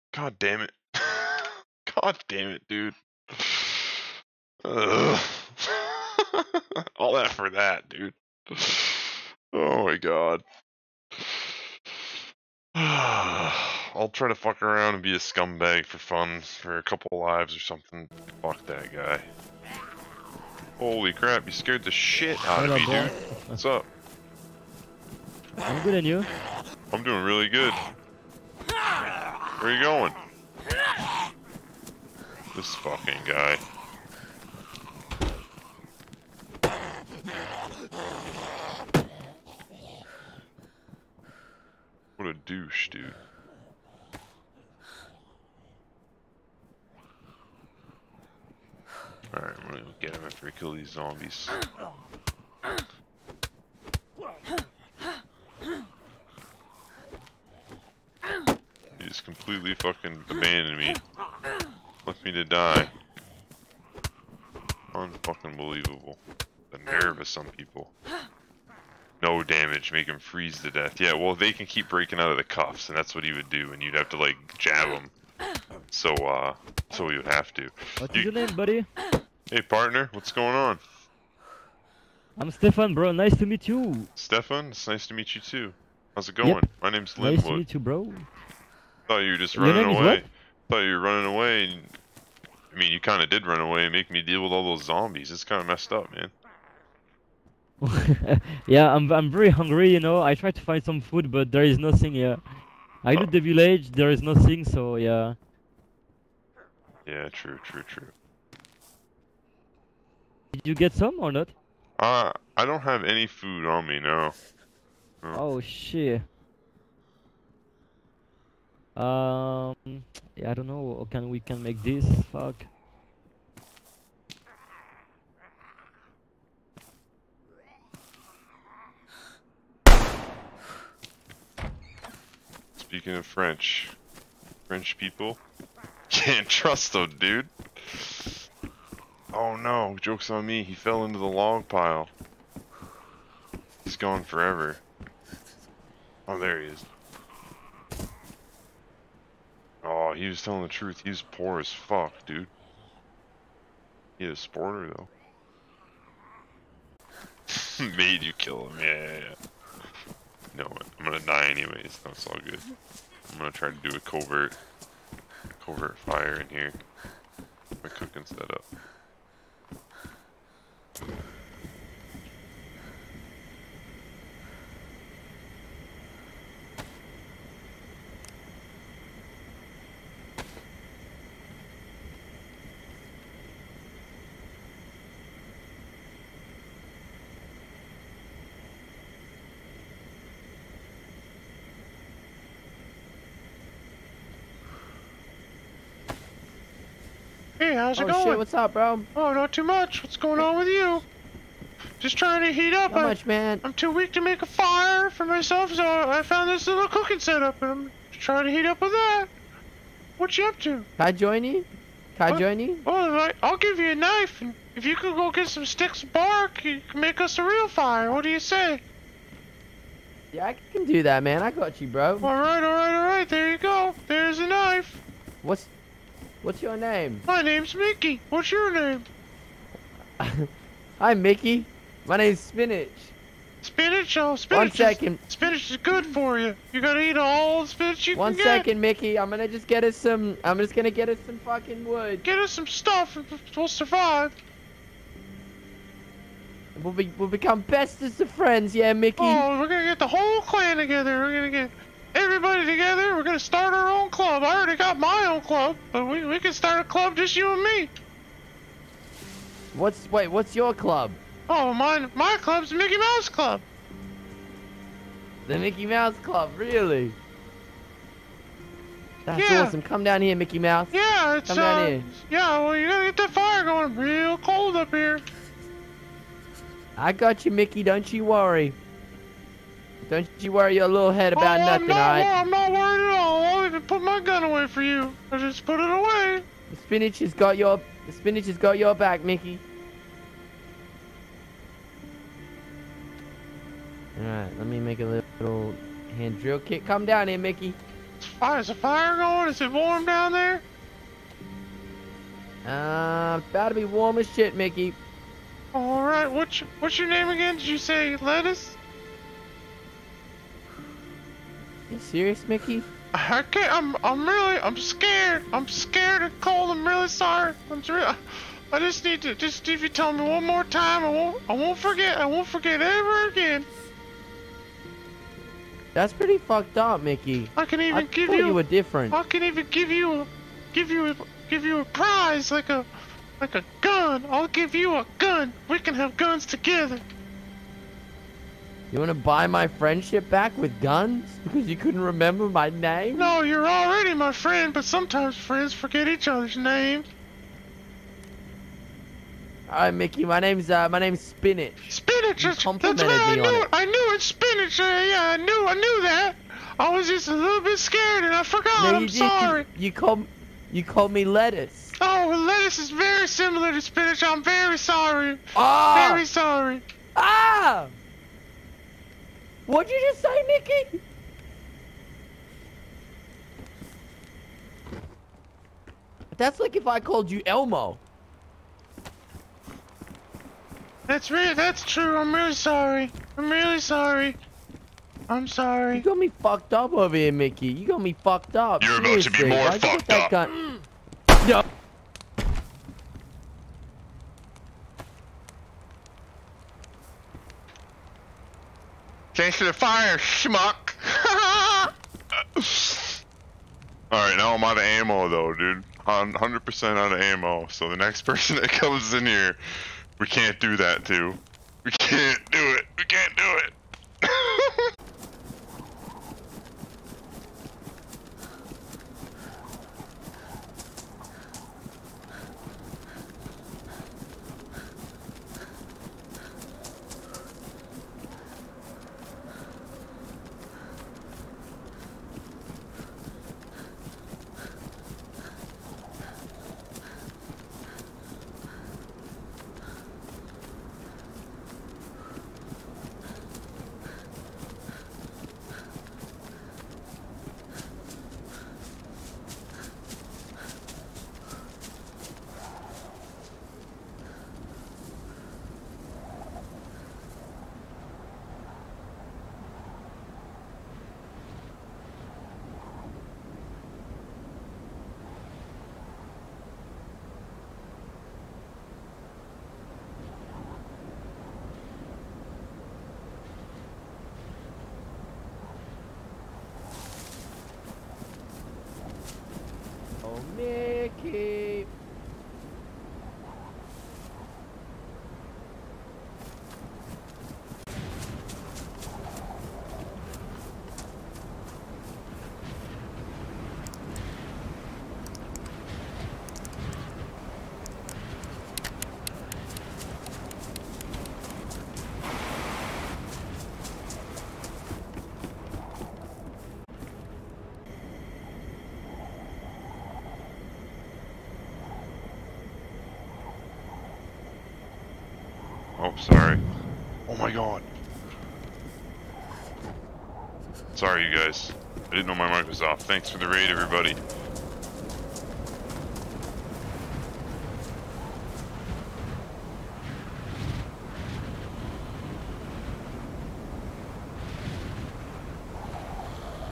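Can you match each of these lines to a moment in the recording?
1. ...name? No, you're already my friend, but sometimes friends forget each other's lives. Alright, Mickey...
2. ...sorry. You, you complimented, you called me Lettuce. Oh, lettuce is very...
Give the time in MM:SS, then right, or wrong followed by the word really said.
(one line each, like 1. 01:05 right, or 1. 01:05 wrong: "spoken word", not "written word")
1. 05:42 wrong: "names", not "lives"
2. 05:59 wrong: "called", not "complimented".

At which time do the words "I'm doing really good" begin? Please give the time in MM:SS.
00:26.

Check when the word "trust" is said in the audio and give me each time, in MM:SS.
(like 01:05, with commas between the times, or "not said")
02:16.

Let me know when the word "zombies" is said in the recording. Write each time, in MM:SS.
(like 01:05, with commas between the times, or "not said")
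00:50, 01:34.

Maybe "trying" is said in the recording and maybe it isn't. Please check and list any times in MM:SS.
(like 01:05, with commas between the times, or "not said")
03:22, 03:28.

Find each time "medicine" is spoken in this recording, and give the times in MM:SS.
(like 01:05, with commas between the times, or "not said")
not said.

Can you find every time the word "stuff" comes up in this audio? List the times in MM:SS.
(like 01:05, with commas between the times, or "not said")
04:02.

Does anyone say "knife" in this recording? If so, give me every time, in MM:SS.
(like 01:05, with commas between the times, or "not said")
03:33, 03:44.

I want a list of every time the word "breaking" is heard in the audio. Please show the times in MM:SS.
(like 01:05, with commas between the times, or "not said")
01:11.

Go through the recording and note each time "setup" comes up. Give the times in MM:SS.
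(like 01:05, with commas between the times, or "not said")
02:48, 03:27.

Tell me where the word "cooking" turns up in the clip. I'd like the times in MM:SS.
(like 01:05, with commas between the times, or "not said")
02:47, 03:26.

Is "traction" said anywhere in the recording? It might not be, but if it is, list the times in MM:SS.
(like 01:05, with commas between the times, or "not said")
not said.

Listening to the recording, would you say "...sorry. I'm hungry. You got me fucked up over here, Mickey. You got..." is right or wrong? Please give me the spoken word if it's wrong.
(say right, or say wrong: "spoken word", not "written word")
wrong: "sorry", not "hungry".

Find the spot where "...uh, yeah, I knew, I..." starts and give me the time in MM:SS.
05:54.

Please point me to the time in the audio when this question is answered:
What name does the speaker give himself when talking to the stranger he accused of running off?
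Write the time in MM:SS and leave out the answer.
01:26.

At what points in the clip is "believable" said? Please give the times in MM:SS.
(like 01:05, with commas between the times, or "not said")
01:05.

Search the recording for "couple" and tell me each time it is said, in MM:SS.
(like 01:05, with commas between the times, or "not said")
00:16.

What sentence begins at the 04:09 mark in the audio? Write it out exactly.
Oh, we're gonna get the whole clan together.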